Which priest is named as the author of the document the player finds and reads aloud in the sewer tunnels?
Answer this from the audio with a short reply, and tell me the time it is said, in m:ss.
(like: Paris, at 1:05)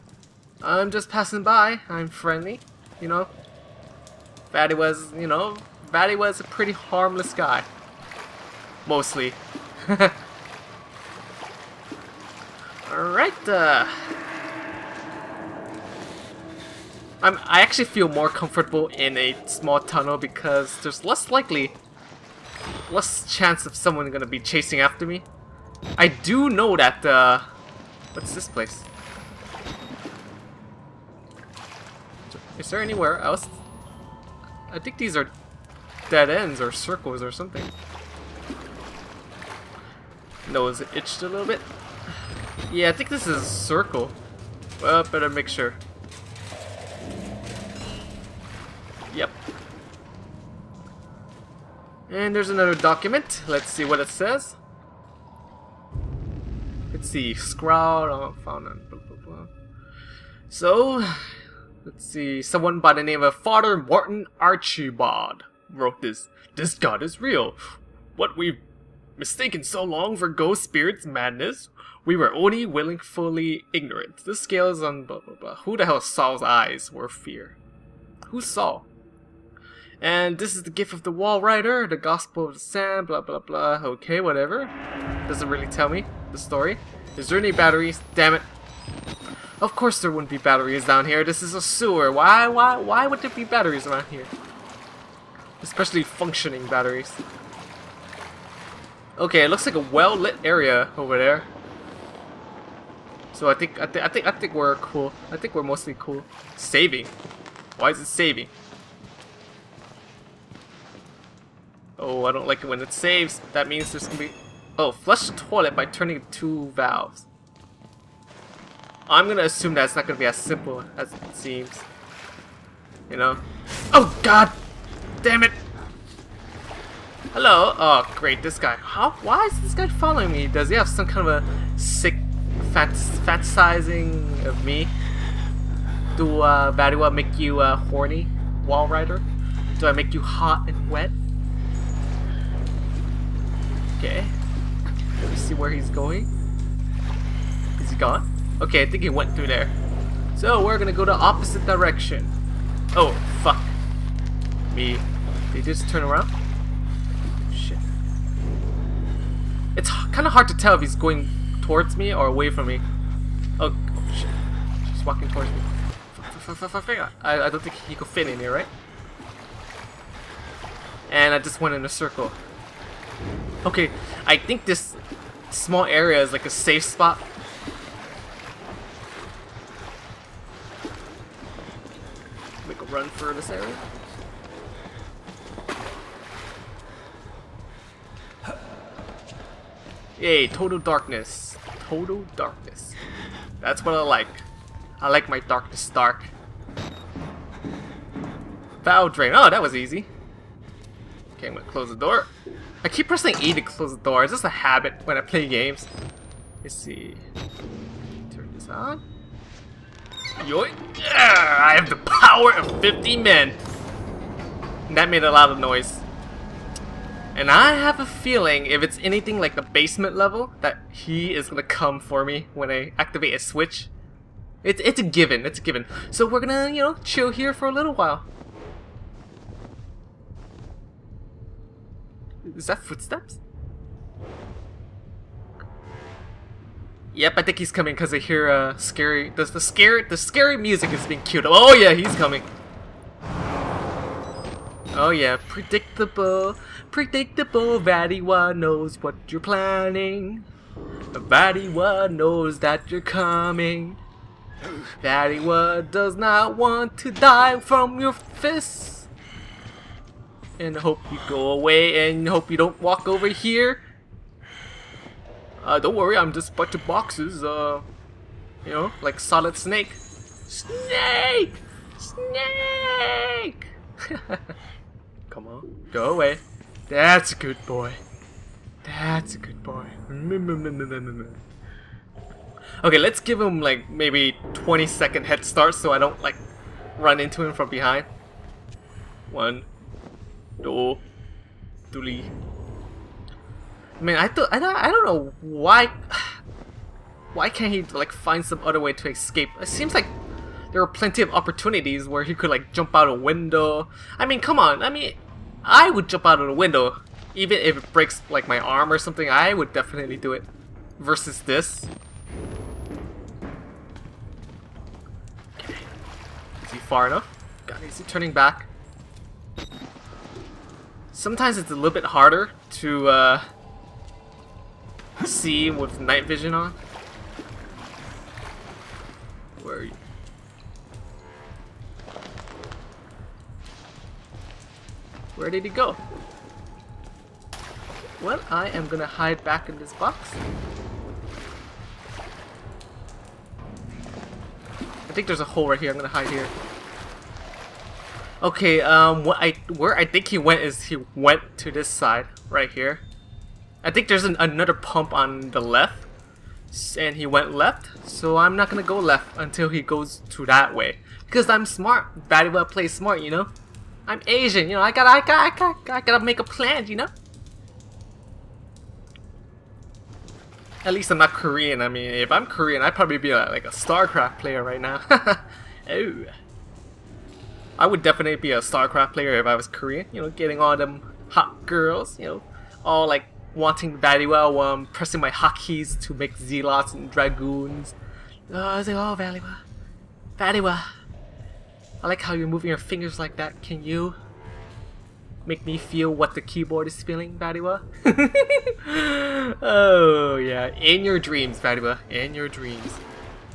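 Father Martin Archimbaud, at 1:03.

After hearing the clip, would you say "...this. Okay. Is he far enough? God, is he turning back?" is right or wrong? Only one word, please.
right.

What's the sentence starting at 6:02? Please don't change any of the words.
Daddy well play smart, you know.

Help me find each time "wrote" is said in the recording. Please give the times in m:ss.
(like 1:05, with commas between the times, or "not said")
1:05.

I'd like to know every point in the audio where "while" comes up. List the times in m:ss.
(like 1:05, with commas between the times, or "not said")
3:47, 6:24.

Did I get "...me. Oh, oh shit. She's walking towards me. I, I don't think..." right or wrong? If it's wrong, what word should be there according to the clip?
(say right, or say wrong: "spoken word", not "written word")
right.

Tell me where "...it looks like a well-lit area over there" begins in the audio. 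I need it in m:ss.
1:39.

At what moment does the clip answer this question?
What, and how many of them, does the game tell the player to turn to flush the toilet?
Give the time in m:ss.
1:56.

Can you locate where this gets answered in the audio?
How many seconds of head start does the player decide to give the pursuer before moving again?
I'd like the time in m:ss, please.
4:44.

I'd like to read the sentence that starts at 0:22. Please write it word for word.
less chance of someone gonna be chasing after me.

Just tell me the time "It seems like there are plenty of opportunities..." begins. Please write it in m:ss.
4:59.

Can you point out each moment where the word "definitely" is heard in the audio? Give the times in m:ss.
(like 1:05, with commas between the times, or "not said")
5:09, 6:18.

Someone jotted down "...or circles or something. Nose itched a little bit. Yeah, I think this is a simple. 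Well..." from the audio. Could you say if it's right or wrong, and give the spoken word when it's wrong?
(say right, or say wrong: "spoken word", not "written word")
wrong: "circle", not "simple".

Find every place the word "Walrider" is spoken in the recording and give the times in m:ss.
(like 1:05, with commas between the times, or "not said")
1:21, 2:18.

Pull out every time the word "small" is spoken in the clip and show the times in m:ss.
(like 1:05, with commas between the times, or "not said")
0:19, 2:55.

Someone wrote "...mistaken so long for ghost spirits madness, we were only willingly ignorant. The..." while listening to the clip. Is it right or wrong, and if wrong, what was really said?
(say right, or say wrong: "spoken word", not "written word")
right.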